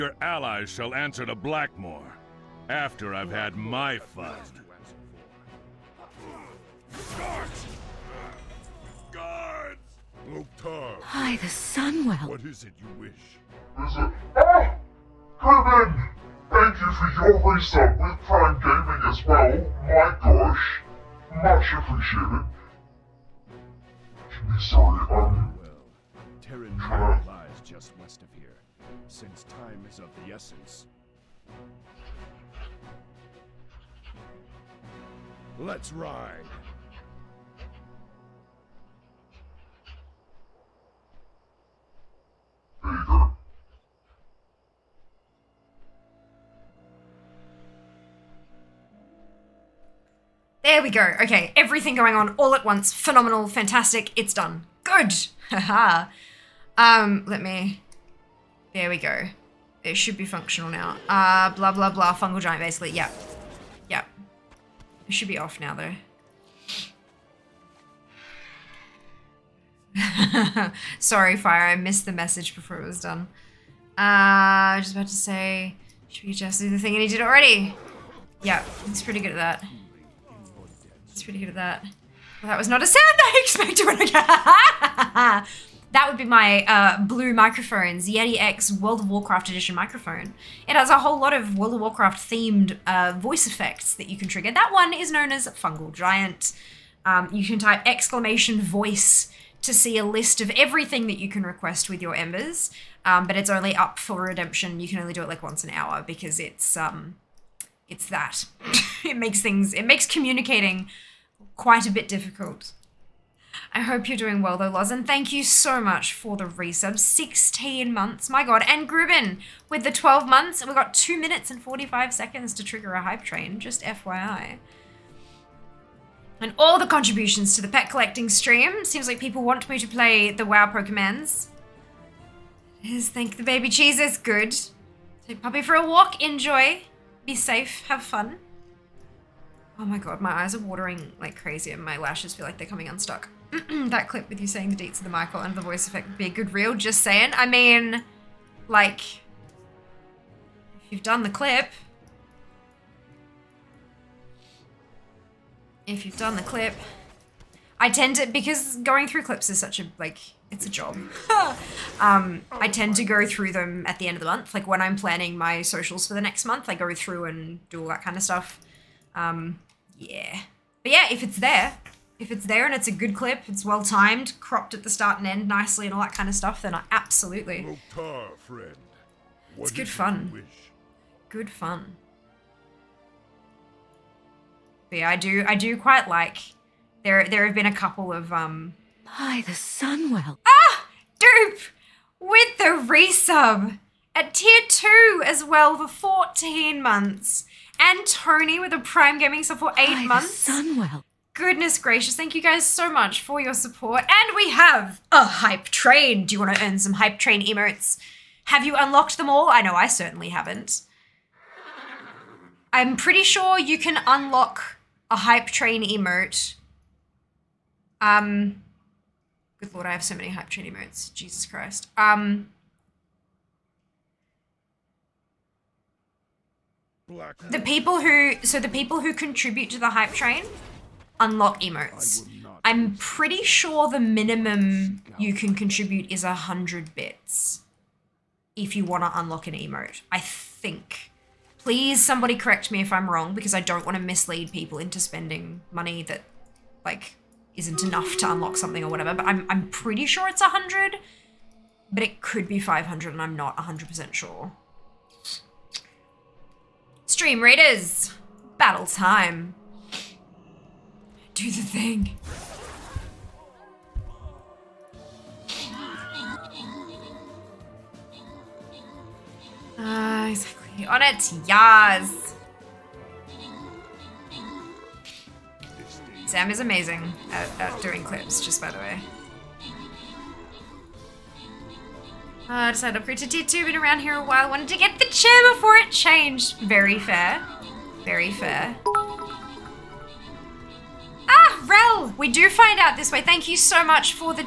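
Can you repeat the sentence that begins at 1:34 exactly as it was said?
That one is known as Fungal Giant.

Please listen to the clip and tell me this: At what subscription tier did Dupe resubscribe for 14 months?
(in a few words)
Tier 2.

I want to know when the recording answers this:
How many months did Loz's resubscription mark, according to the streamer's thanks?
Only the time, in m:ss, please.
1:56.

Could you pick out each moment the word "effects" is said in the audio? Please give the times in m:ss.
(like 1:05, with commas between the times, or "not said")
1:33, 2:25.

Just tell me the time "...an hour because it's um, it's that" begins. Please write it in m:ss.
1:45.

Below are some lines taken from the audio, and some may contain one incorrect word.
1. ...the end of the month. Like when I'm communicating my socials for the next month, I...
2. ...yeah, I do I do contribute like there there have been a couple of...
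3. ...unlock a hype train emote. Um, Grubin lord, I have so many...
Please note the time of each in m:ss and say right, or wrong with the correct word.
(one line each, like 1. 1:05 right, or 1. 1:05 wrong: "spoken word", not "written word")
1. 2:43 wrong: "planning", not "communicating"
2. 3:04 wrong: "quite", not "contribute"
3. 3:34 wrong: "Good", not "Grubin".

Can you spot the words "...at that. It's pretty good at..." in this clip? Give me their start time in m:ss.
1:19.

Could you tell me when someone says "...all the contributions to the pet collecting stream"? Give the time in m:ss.
2:06.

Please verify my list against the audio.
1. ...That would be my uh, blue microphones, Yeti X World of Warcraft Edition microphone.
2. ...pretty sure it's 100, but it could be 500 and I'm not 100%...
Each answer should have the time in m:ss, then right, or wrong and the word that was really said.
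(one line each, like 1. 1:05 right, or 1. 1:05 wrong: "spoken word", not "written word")
1. 1:25 right
2. 4:09 right.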